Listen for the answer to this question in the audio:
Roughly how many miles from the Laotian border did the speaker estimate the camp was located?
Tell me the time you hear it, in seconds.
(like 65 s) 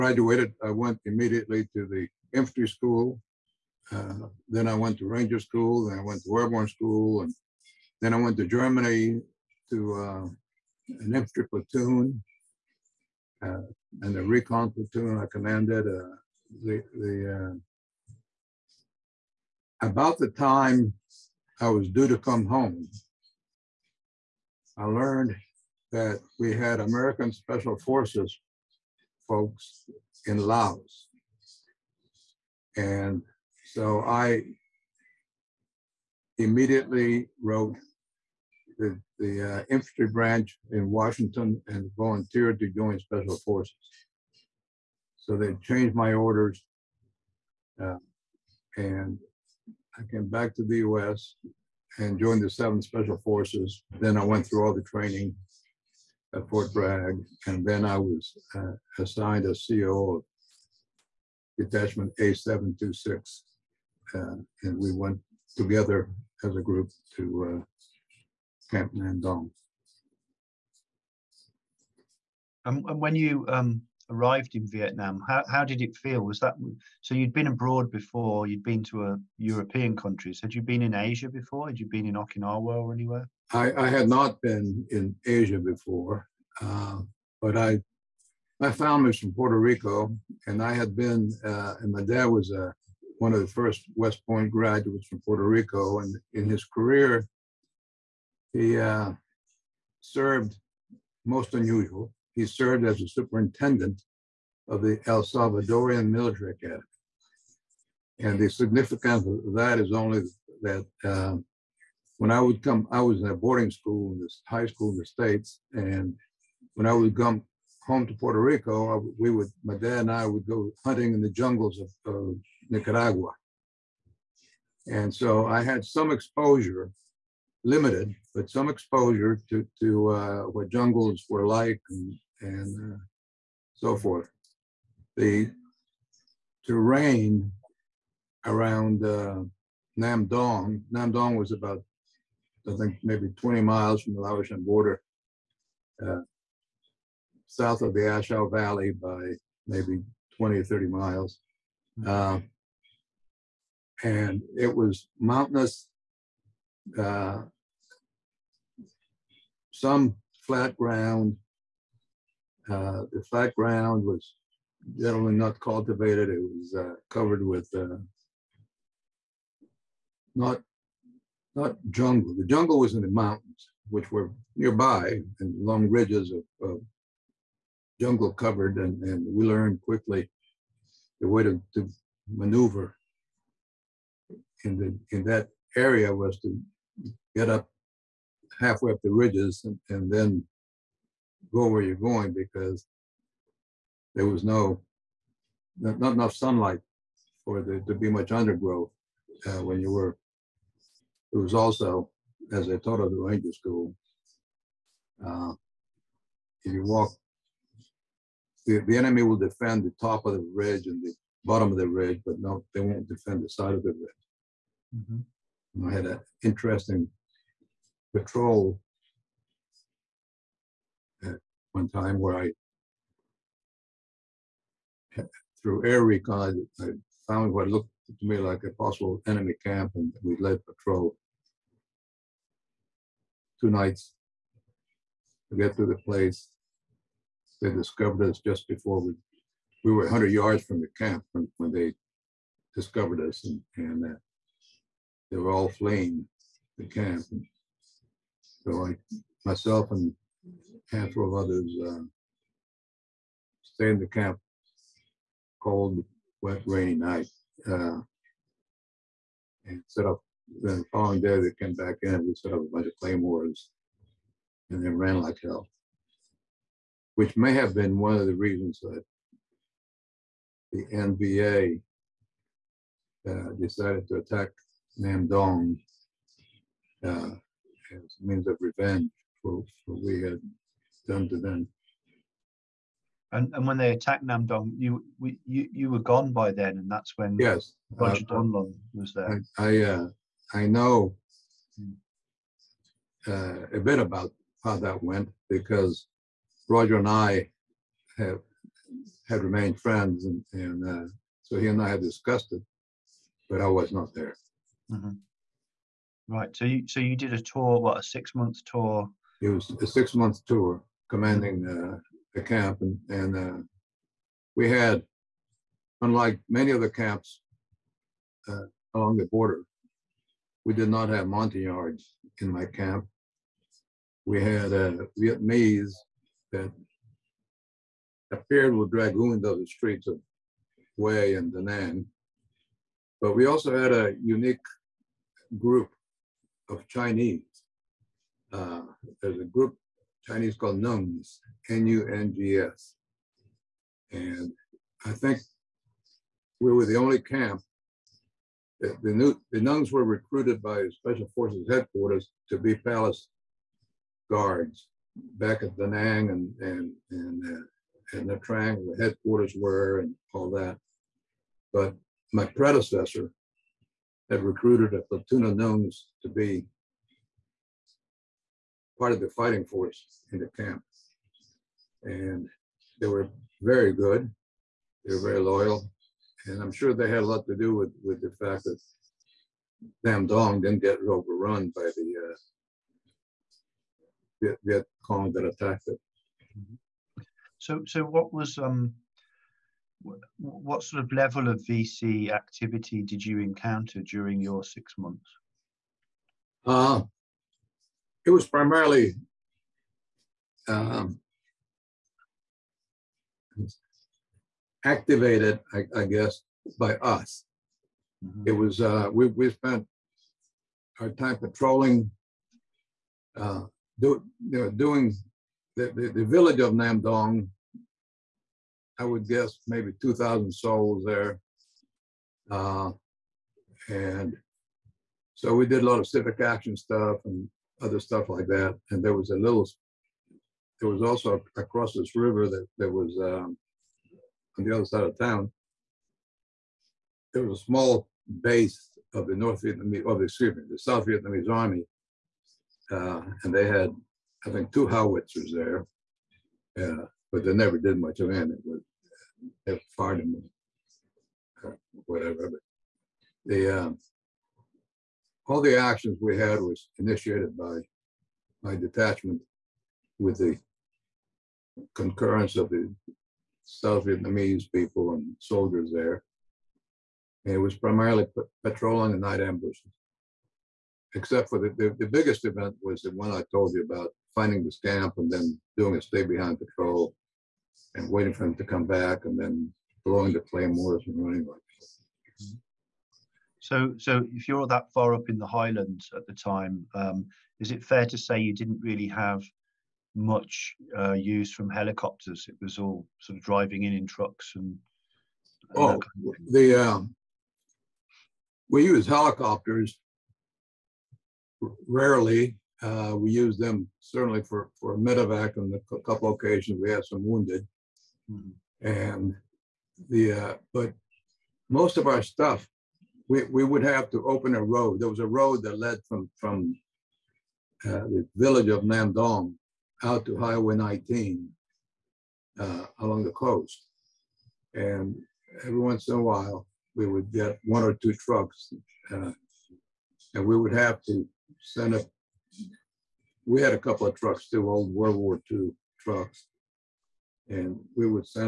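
143 s.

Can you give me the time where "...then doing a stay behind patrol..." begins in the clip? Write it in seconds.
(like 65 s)
475 s.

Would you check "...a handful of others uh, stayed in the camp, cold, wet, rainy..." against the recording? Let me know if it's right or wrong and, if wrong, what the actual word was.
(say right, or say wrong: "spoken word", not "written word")
right.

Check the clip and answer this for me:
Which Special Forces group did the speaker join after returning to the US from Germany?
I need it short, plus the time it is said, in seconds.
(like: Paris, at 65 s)
7th Special Forces, at 52 s.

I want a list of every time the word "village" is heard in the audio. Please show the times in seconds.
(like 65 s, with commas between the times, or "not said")
416 s, 518 s.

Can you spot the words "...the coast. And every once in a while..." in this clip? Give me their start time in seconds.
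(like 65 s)
523 s.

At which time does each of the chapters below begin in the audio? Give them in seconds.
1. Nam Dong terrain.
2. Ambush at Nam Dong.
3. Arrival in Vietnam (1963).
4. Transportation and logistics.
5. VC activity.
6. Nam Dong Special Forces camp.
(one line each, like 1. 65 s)
1. 136 s
2. 215 s
3. 71 s
4. 481 s
5. 391 s
6. 283 s.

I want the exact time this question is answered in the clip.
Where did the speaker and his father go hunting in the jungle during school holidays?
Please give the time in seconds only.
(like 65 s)
122 s.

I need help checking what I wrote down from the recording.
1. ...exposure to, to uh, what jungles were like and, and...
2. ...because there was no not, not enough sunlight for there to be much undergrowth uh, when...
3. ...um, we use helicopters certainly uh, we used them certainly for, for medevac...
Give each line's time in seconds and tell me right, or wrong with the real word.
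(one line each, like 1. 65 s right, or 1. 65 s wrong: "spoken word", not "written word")
1. 128 s right
2. 192 s right
3. 496 s wrong: "rarely", not "certainly".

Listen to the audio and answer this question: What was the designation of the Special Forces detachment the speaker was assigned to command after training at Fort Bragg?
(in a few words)
A726.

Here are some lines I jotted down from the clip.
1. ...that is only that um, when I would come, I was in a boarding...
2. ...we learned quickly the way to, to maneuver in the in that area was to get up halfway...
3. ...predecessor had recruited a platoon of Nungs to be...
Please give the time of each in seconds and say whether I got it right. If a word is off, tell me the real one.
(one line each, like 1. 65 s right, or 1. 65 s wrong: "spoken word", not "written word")
1. 109 s right
2. 179 s right
3. 362 s right.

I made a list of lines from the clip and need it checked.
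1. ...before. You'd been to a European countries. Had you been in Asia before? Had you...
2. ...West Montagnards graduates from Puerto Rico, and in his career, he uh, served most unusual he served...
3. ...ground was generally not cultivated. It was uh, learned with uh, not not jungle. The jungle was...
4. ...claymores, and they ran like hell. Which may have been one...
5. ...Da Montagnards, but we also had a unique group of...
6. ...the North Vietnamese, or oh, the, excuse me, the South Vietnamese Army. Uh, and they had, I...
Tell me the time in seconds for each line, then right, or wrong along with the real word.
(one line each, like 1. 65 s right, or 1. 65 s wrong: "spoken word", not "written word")
1. 77 s right
2. 93 s wrong: "Point", not "Montagnards"
3. 163 s wrong: "covered", not "learned"
4. 262 s right
5. 331 s wrong: "Nang", not "Montagnards"
6. 439 s right.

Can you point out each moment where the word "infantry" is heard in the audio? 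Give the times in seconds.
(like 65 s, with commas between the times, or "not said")
2 s, 11 s, 39 s.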